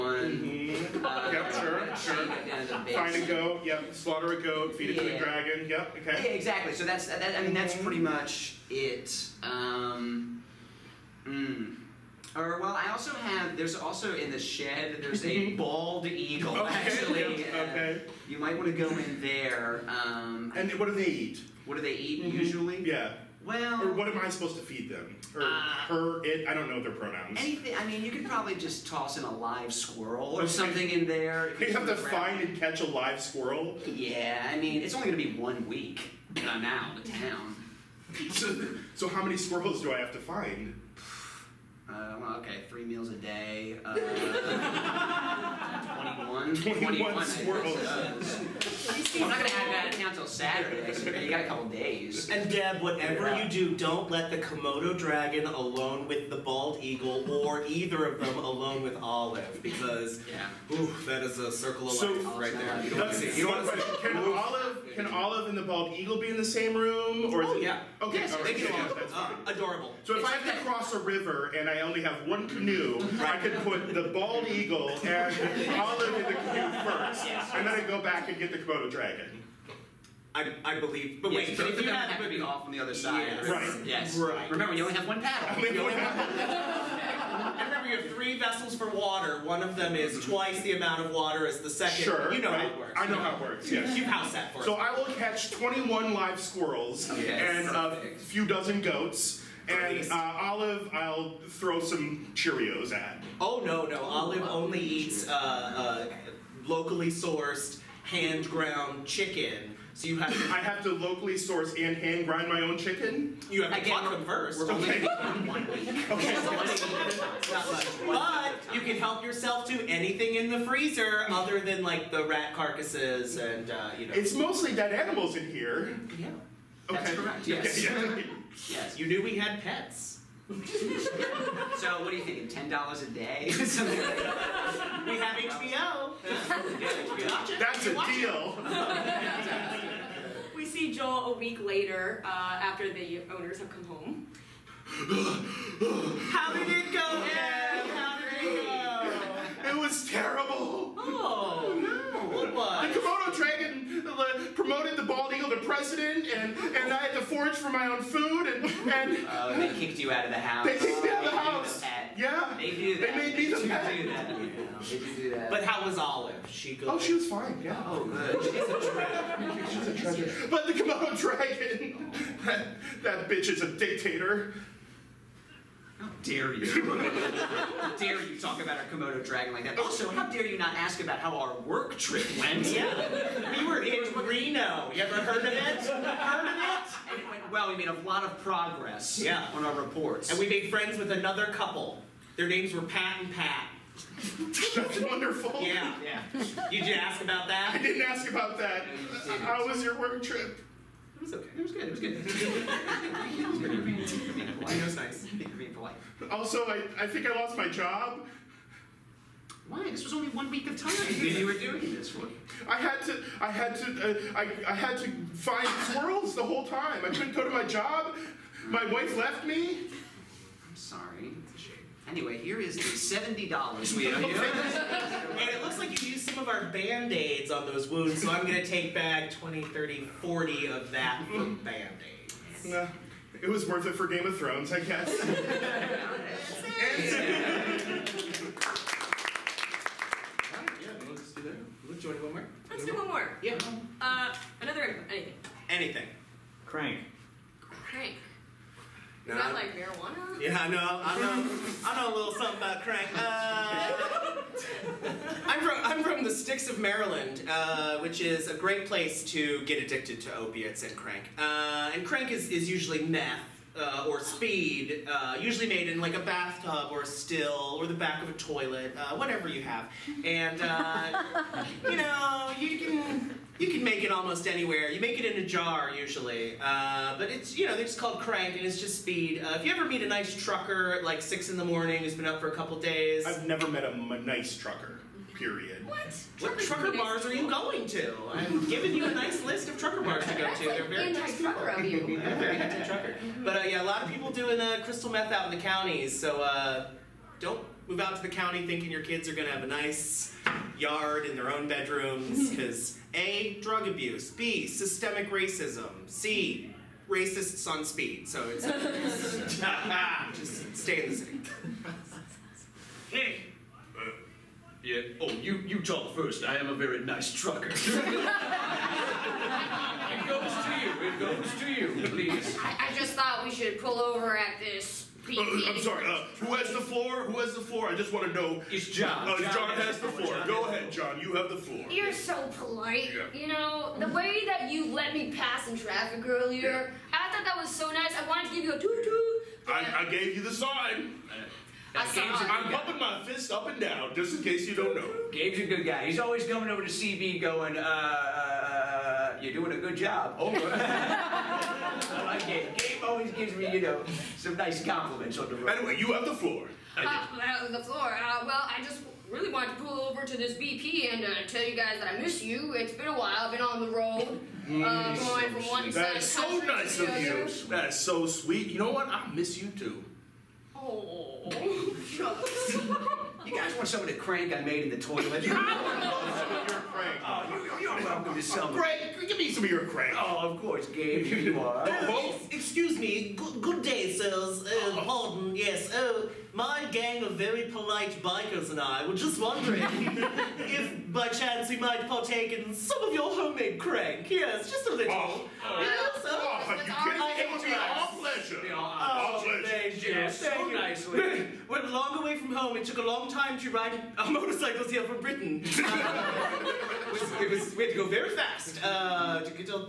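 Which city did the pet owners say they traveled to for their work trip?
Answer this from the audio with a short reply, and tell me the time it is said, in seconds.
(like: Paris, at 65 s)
Reno, at 184 s.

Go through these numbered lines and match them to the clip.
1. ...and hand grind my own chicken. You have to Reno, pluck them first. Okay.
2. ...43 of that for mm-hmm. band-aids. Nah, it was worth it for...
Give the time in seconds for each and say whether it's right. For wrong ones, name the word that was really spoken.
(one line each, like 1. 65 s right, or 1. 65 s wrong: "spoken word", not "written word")
1. 111 s wrong: "Again", not "Reno"
2. 230 s wrong: "40", not "43".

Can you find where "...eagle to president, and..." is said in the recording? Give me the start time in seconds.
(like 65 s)
155 s.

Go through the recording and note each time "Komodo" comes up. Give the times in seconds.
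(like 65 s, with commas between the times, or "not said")
54 s, 78 s, 170 s, 178 s.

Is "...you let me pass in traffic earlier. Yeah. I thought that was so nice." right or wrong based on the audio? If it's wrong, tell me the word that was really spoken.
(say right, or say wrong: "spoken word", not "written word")
right.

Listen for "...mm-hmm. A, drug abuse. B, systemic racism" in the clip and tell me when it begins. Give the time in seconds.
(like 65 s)
302 s.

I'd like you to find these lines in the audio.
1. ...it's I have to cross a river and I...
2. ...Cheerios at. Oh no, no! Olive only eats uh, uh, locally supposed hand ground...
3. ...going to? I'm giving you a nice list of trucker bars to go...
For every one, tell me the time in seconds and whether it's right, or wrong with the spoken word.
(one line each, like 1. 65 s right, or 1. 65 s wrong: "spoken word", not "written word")
1. 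70 s right
2. 102 s wrong: "sourced", not "supposed"
3. 287 s right.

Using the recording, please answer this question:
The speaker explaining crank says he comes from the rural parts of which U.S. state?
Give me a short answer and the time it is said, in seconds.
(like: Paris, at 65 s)
Maryland, at 256 s.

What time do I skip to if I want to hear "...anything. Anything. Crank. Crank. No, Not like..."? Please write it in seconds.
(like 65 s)
245 s.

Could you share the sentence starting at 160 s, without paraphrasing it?
They kicked me out of the house.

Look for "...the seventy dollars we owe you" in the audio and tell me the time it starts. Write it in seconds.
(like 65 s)
222 s.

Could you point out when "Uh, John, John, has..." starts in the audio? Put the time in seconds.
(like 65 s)
329 s.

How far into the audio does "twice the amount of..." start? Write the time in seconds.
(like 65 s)
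90 s.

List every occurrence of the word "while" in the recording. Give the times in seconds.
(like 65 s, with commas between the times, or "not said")
363 s.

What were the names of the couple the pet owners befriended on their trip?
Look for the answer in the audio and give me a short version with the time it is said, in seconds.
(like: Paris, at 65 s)
Pat and Pat, at 192 s.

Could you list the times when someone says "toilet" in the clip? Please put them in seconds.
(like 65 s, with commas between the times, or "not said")
268 s, 374 s.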